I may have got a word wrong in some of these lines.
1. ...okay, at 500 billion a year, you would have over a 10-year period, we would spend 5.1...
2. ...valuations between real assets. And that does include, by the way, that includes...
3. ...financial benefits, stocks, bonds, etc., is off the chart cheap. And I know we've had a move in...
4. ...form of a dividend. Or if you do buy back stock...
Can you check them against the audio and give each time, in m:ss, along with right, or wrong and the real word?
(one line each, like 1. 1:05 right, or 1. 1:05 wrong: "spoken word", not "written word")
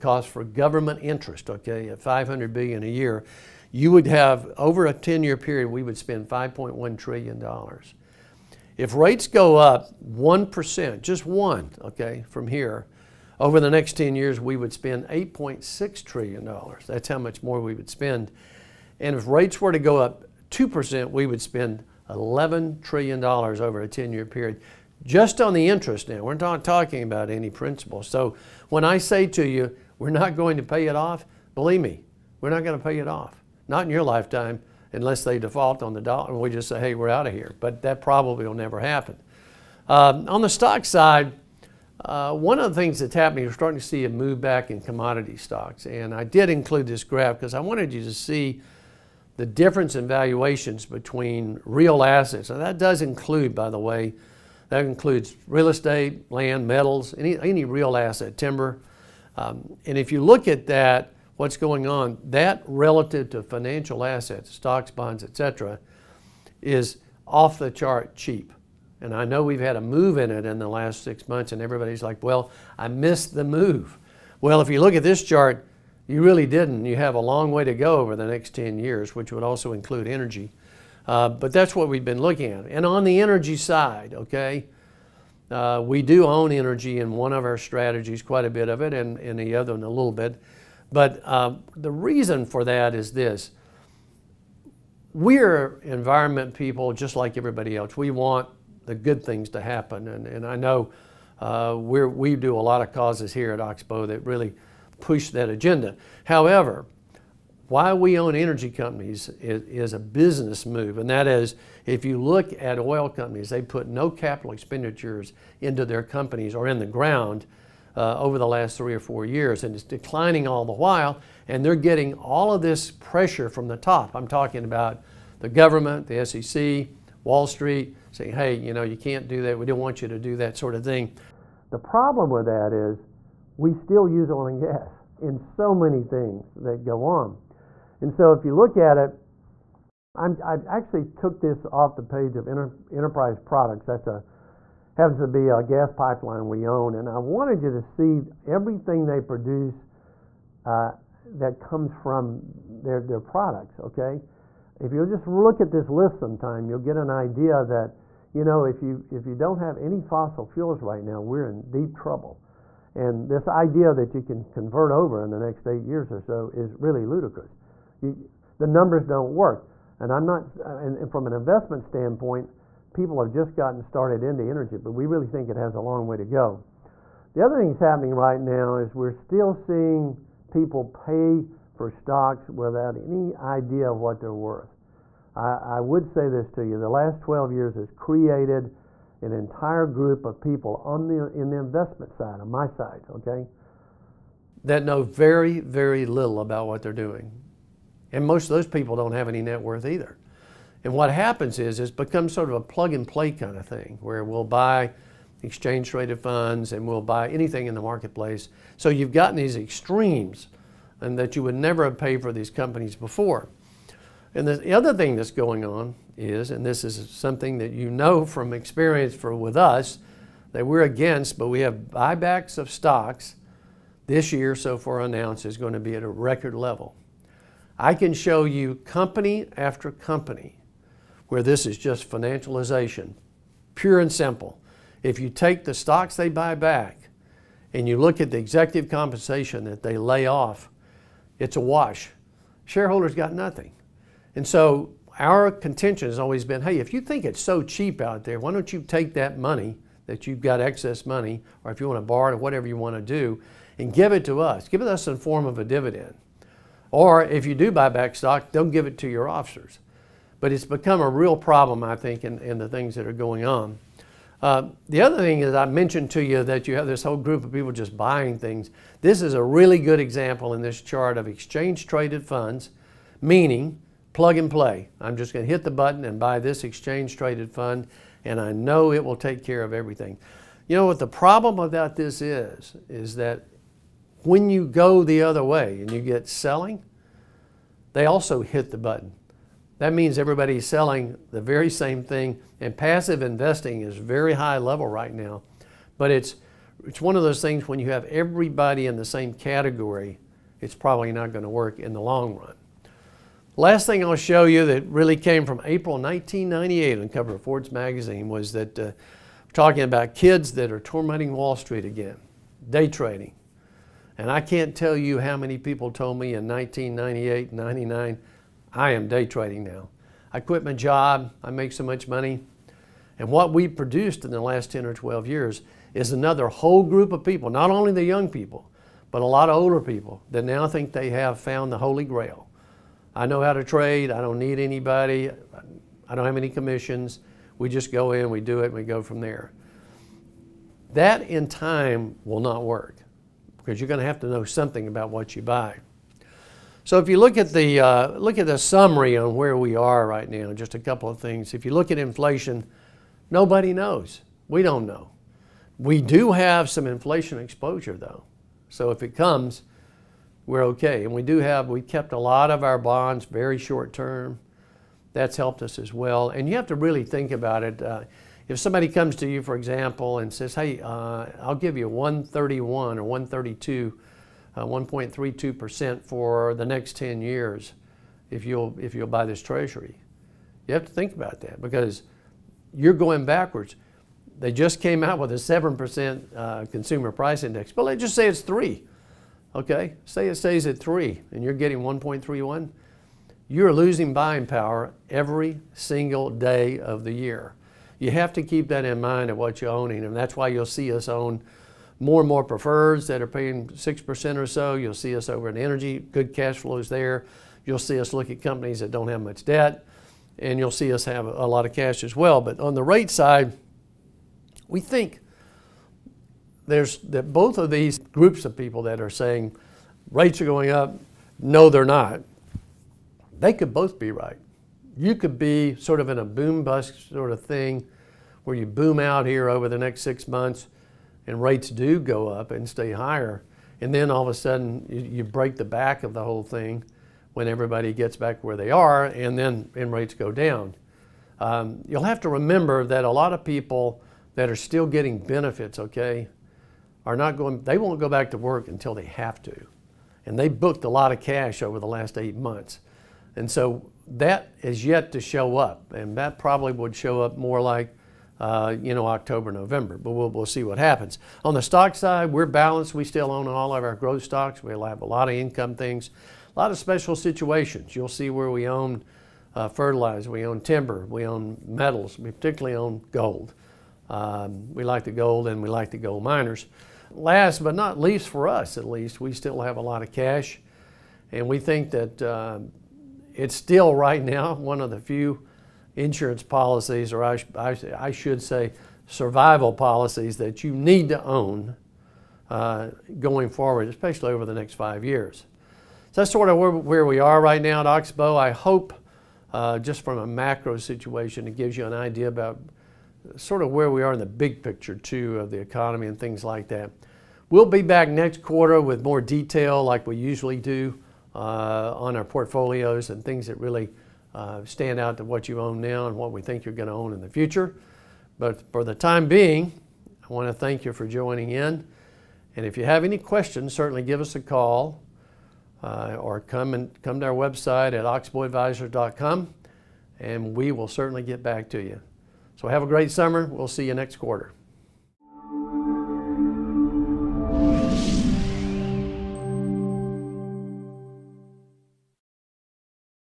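1. 0:01 right
2. 0:50 right
3. 1:03 wrong: "assets", not "benefits"
4. 4:15 right.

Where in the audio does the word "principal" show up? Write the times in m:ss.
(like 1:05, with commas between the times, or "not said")
0:27.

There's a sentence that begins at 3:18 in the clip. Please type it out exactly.
And most of those people don't have any net worth either.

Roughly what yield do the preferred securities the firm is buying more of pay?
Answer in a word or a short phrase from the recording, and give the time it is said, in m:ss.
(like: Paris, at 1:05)
6%, at 6:43.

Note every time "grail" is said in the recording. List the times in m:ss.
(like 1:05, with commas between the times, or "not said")
5:32.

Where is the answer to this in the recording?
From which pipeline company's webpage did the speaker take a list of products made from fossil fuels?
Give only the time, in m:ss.
2:22.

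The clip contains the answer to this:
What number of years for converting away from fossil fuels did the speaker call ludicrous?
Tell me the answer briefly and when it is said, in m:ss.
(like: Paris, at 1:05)
8, at 2:45.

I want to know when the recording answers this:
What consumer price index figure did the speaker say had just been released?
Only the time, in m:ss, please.
6:25.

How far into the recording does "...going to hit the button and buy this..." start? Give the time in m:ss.
4:35.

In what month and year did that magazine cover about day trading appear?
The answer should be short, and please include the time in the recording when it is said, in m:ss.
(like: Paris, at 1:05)
April 1998, at 5:05.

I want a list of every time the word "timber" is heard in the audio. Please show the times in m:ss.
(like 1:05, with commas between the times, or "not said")
0:58, 7:50.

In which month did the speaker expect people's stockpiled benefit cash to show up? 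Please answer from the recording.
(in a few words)
October.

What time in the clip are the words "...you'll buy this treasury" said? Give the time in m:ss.
6:18.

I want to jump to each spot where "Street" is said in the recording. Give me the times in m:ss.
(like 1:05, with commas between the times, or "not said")
2:07, 5:11.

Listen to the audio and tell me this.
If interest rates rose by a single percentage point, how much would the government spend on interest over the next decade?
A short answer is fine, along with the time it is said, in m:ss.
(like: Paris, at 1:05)
$8.6 trillion, at 0:15.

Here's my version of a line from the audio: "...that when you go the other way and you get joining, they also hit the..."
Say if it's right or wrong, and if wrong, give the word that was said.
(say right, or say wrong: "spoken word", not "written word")
wrong: "selling", not "joining".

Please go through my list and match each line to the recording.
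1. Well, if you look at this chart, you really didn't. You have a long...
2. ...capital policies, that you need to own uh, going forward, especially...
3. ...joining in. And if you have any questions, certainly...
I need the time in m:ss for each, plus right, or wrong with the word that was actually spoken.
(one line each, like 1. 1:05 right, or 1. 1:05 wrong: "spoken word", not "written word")
1. 1:14 right
2. 8:09 wrong: "survival", not "capital"
3. 8:41 right.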